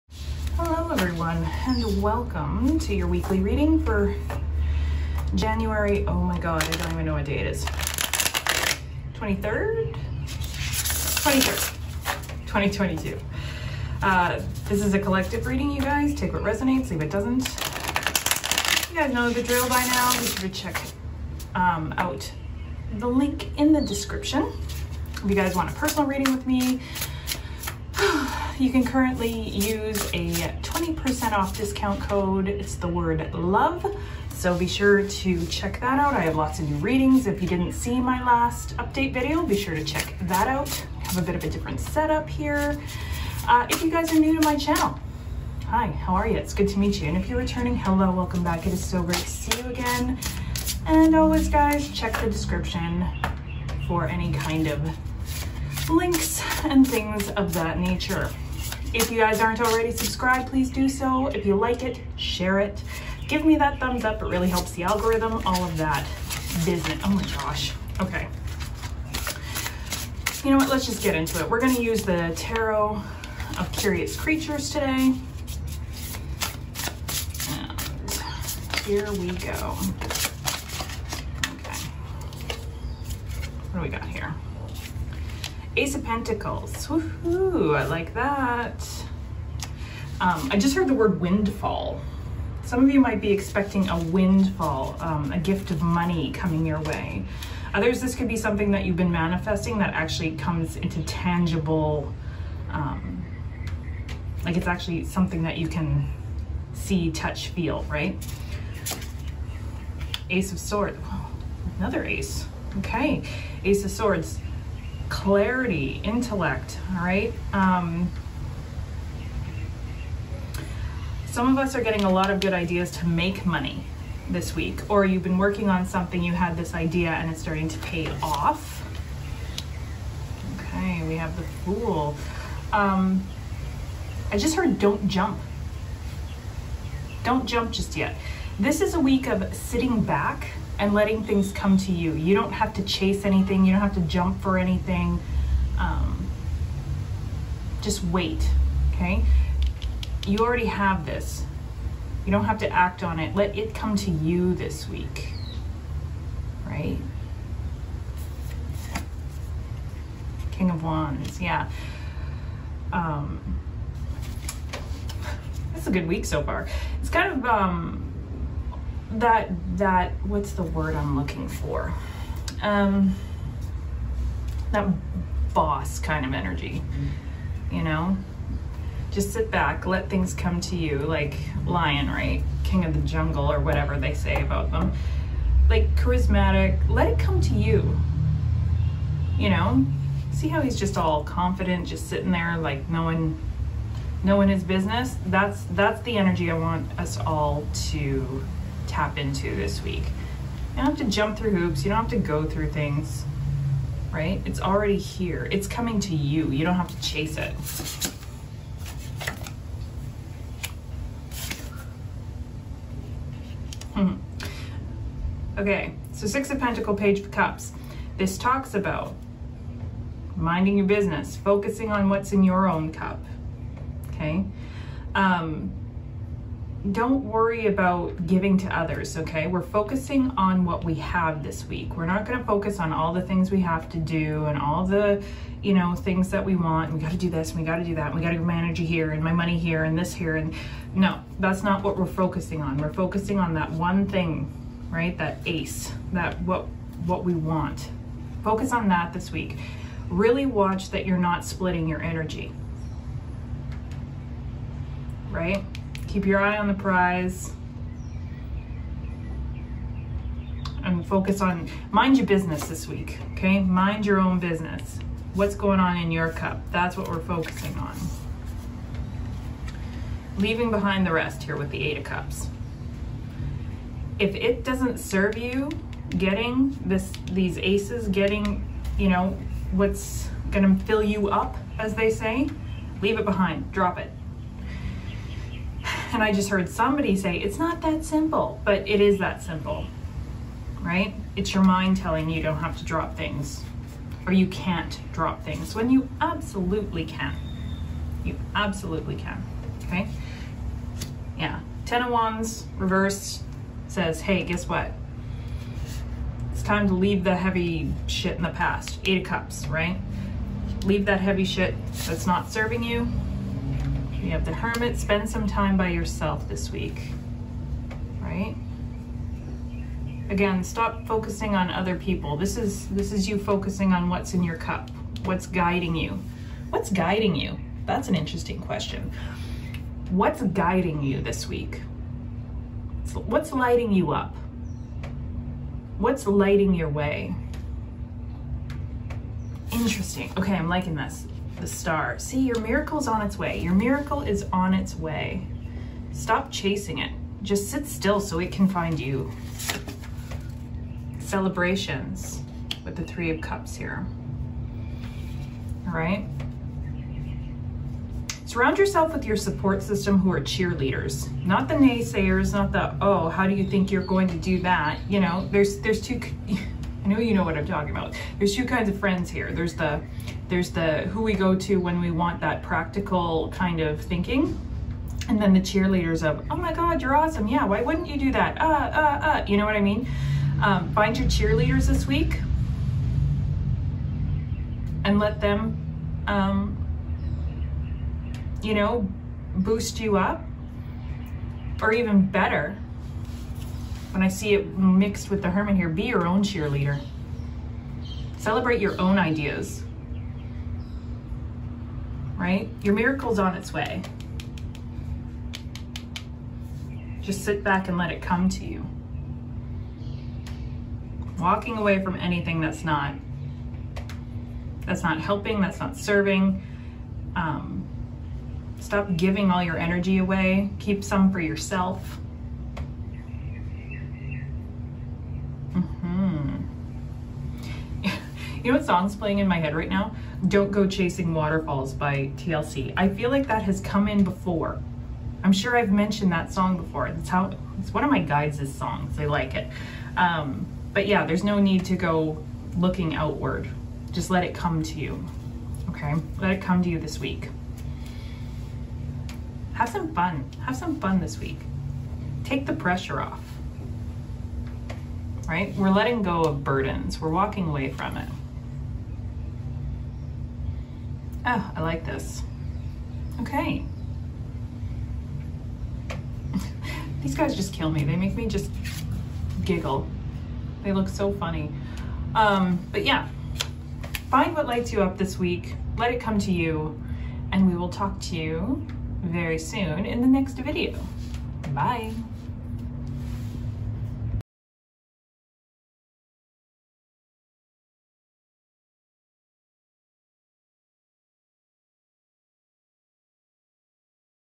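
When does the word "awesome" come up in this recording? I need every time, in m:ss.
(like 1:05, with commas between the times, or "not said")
6:17.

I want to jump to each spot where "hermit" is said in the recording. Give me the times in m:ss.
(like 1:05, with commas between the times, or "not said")
5:14, 6:35.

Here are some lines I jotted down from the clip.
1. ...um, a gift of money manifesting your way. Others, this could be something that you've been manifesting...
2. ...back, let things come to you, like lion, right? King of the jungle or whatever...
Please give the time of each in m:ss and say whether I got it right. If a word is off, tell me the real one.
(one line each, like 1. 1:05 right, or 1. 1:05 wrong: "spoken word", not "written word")
1. 1:34 wrong: "coming", not "manifesting"
2. 2:59 right.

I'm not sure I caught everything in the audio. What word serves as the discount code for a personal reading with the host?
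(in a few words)
love.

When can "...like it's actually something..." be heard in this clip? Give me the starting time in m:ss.
1:44.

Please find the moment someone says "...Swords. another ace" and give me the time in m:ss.
1:50.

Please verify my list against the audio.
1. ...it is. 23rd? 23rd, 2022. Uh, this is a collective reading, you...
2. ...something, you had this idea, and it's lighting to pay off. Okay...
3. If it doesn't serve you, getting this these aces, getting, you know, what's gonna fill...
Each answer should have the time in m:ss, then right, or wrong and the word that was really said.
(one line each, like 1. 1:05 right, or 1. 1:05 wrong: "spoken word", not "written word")
1. 0:07 right
2. 2:05 wrong: "starting", not "lighting"
3. 4:34 right.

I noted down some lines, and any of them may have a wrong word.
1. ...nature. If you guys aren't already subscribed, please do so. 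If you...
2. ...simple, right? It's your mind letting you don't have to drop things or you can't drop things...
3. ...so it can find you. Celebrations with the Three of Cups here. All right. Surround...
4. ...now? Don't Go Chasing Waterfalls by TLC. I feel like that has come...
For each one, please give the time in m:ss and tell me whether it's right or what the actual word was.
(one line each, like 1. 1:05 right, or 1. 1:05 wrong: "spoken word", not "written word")
1. 0:57 right
2. 4:49 wrong: "telling", not "letting"
3. 5:48 right
4. 7:09 right.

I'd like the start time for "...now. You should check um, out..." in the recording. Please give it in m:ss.
0:19.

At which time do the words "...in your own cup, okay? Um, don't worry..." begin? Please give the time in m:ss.
3:42.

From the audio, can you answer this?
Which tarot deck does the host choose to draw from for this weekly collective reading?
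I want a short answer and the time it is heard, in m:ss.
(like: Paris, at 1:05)
Tarot of Curious Creatures, at 1:12.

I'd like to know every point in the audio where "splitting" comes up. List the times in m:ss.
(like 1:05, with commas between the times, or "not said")
4:11.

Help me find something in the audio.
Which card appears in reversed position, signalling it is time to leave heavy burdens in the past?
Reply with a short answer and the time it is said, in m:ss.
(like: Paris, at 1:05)
10 of Wands, at 5:01.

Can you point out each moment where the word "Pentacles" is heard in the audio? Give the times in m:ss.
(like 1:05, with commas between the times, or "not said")
1:26, 3:36.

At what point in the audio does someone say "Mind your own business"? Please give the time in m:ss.
4:23.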